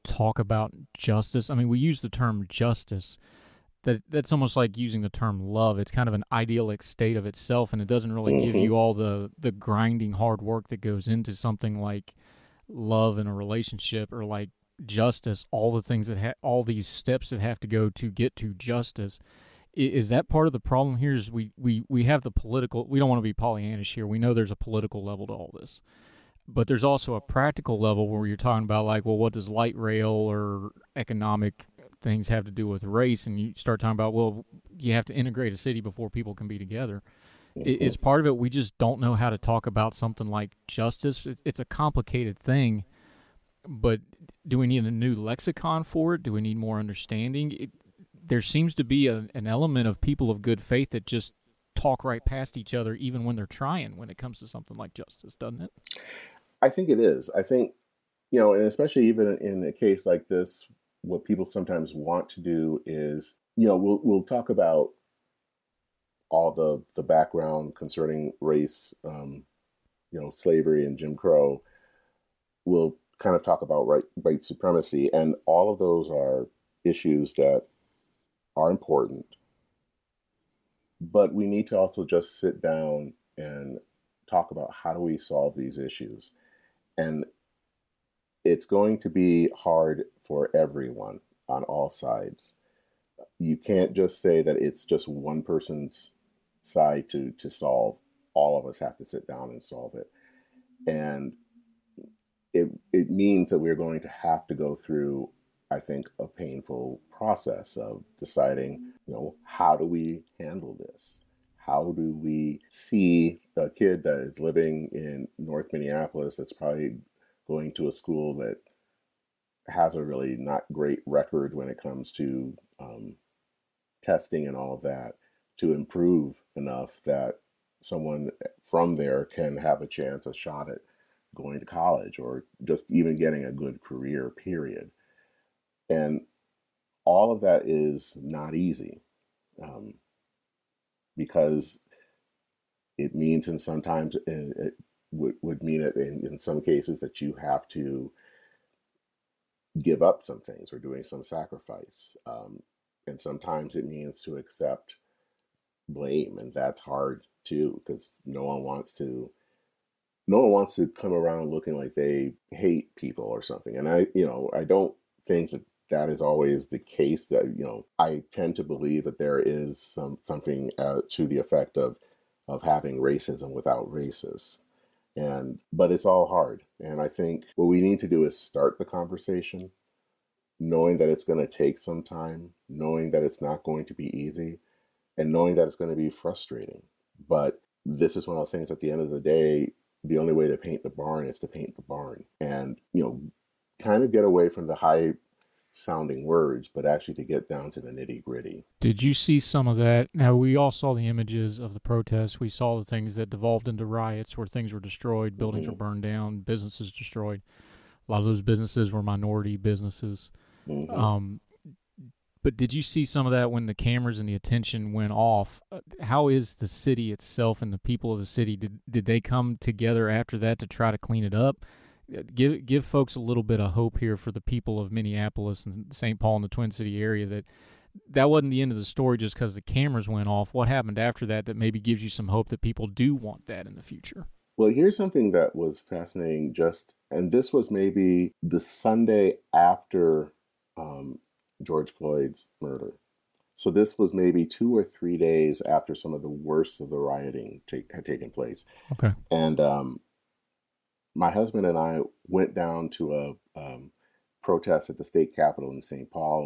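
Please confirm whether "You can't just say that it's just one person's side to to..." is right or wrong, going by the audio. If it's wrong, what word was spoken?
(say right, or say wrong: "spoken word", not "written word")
right.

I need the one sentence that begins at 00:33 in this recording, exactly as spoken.
And you start talking about, well, you have to integrate a city before people can be together.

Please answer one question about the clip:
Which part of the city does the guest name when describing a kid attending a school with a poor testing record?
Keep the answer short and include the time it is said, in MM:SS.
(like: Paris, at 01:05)
North Minneapolis, at 01:55.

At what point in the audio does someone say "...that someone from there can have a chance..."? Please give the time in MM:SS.
02:07.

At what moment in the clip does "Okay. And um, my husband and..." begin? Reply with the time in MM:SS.
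04:08.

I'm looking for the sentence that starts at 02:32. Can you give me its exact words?
Um, and sometimes it means to accept blame, and that's hard too because no one wants to.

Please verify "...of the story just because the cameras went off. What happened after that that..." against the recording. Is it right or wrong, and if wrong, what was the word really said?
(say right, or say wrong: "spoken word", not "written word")
right.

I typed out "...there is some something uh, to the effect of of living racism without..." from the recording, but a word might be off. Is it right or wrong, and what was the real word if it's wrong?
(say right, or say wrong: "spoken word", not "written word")
wrong: "having", not "living".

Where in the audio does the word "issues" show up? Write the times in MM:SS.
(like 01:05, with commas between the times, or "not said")
01:16, 01:25.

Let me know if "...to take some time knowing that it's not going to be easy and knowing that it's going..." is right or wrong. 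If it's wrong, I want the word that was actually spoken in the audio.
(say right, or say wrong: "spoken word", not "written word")
right.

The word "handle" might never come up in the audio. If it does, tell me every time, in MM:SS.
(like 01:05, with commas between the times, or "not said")
01:50.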